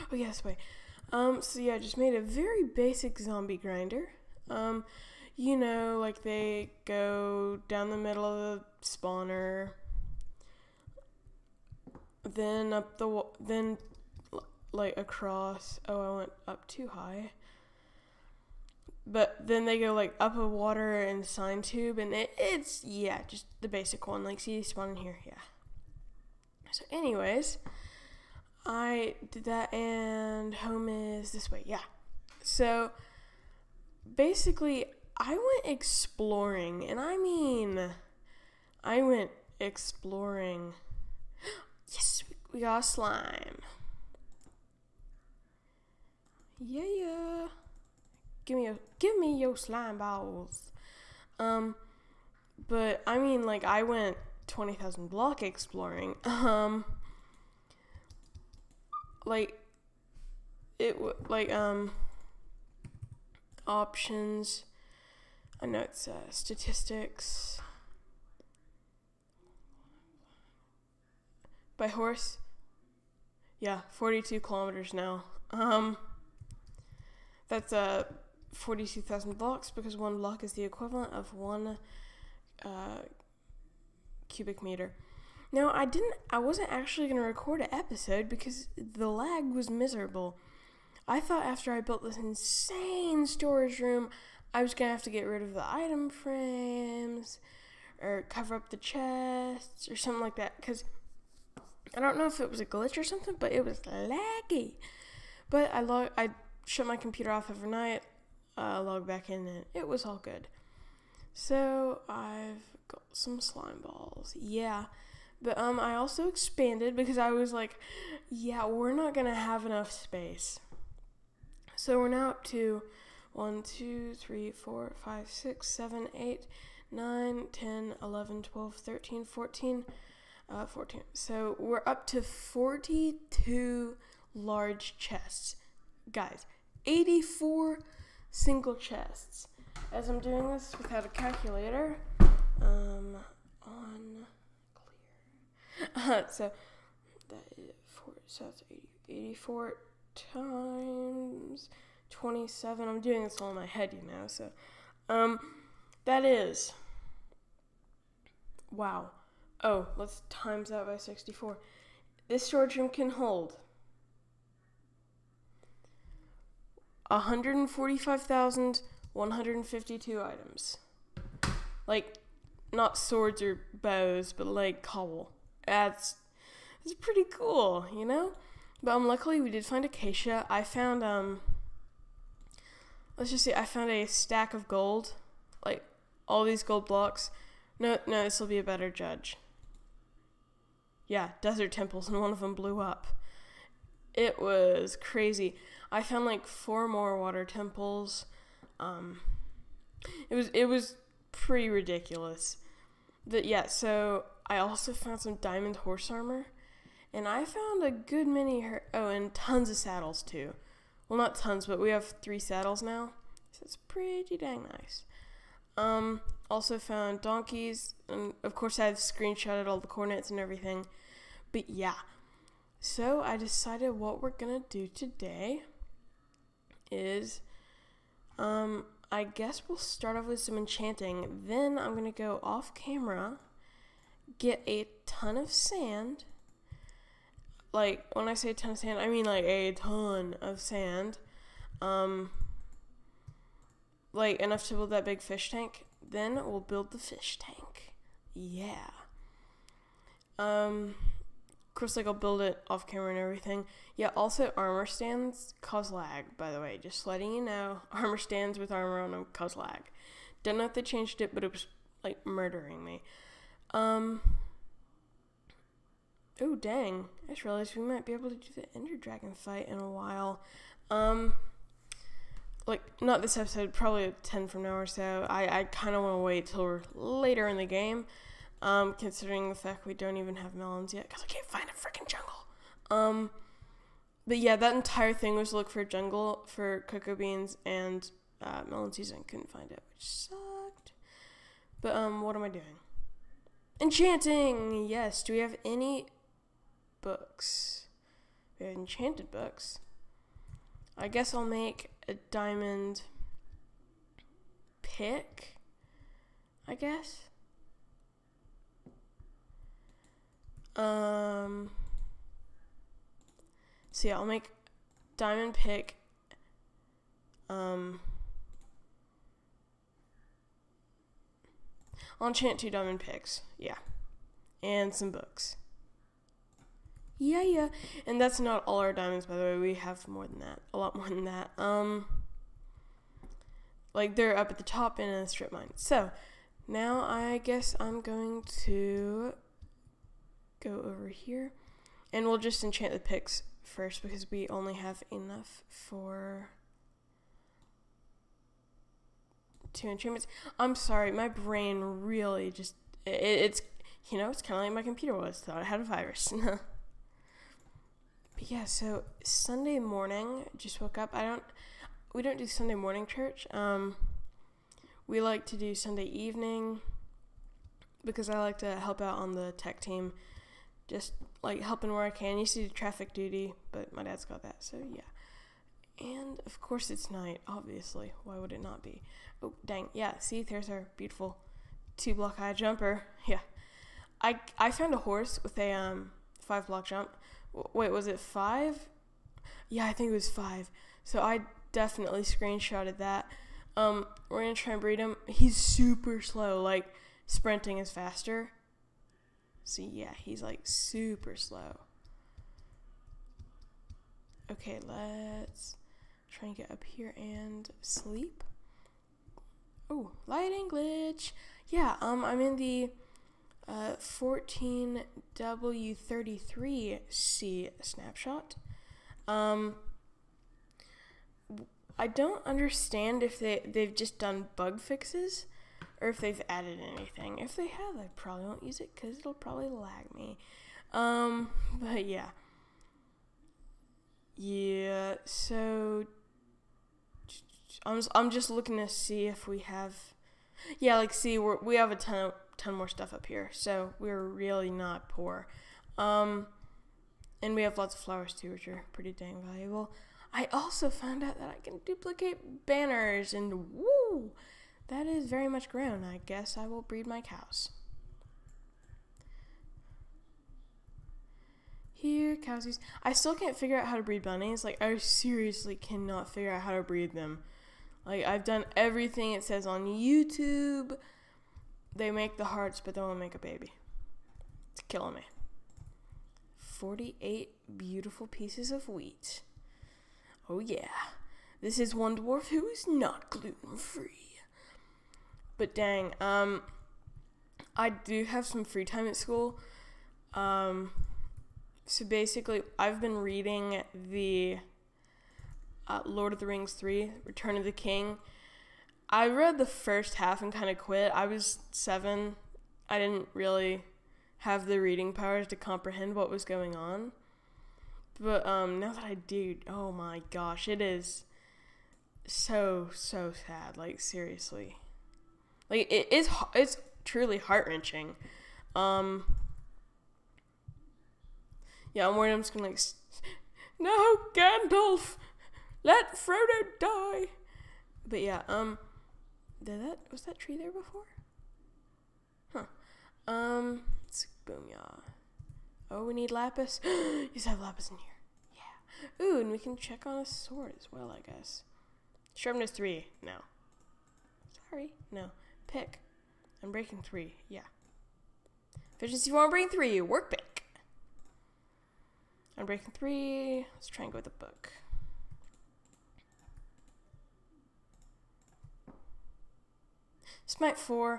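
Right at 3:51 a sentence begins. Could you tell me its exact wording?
Then I'm gonna go off camera get a ton of sand.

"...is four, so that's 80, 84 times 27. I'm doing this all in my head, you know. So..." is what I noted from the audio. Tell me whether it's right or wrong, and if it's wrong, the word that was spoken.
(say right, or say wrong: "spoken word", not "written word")
right.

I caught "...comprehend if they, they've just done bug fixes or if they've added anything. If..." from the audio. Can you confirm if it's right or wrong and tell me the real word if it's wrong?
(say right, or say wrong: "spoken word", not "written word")
wrong: "understand", not "comprehend".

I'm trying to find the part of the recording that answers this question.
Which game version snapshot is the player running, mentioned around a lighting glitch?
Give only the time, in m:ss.
6:53.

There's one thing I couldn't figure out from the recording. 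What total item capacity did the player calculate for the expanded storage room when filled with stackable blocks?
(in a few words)
145,152.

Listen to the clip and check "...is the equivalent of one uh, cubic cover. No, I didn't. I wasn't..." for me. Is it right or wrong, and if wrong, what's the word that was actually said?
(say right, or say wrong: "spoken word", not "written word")
wrong: "meter", not "cover".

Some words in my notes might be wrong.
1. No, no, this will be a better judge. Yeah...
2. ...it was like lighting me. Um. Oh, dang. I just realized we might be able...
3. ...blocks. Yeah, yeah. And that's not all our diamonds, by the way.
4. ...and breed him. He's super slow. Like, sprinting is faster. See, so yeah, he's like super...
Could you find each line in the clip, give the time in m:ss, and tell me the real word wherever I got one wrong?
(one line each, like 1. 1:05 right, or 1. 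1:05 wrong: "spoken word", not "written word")
1. 3:07 right
2. 4:21 wrong: "murdering", not "lighting"
3. 5:25 wrong: "books", not "blocks"
4. 6:34 right.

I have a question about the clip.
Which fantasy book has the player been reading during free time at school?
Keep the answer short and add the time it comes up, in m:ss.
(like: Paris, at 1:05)
Return of the King, at 8:17.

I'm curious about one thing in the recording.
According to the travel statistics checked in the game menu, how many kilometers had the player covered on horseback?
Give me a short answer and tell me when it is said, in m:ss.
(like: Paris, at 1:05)
42, at 1:13.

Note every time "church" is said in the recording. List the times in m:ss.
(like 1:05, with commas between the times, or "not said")
6:03.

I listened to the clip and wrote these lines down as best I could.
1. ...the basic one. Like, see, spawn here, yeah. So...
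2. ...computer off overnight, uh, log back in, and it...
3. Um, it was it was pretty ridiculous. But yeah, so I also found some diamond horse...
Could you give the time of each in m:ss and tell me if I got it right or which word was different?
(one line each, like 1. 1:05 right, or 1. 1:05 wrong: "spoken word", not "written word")
1. 0:23 right
2. 1:46 right
3. 3:18 right.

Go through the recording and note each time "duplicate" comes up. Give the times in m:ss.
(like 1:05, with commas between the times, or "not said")
7:31.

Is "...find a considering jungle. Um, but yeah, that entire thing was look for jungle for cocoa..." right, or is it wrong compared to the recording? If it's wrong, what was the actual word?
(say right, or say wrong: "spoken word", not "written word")
wrong: "freaking", not "considering".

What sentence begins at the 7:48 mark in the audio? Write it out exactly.
Like I've done everything it says on YouTube.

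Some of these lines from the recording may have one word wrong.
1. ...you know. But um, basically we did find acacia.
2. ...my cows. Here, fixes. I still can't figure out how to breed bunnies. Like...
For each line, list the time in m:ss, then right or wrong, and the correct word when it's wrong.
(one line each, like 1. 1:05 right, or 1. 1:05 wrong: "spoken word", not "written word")
1. 2:57 wrong: "luckily", not "basically"
2. 7:37 wrong: "cowsies", not "fixes".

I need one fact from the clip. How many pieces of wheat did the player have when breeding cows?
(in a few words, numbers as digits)
48.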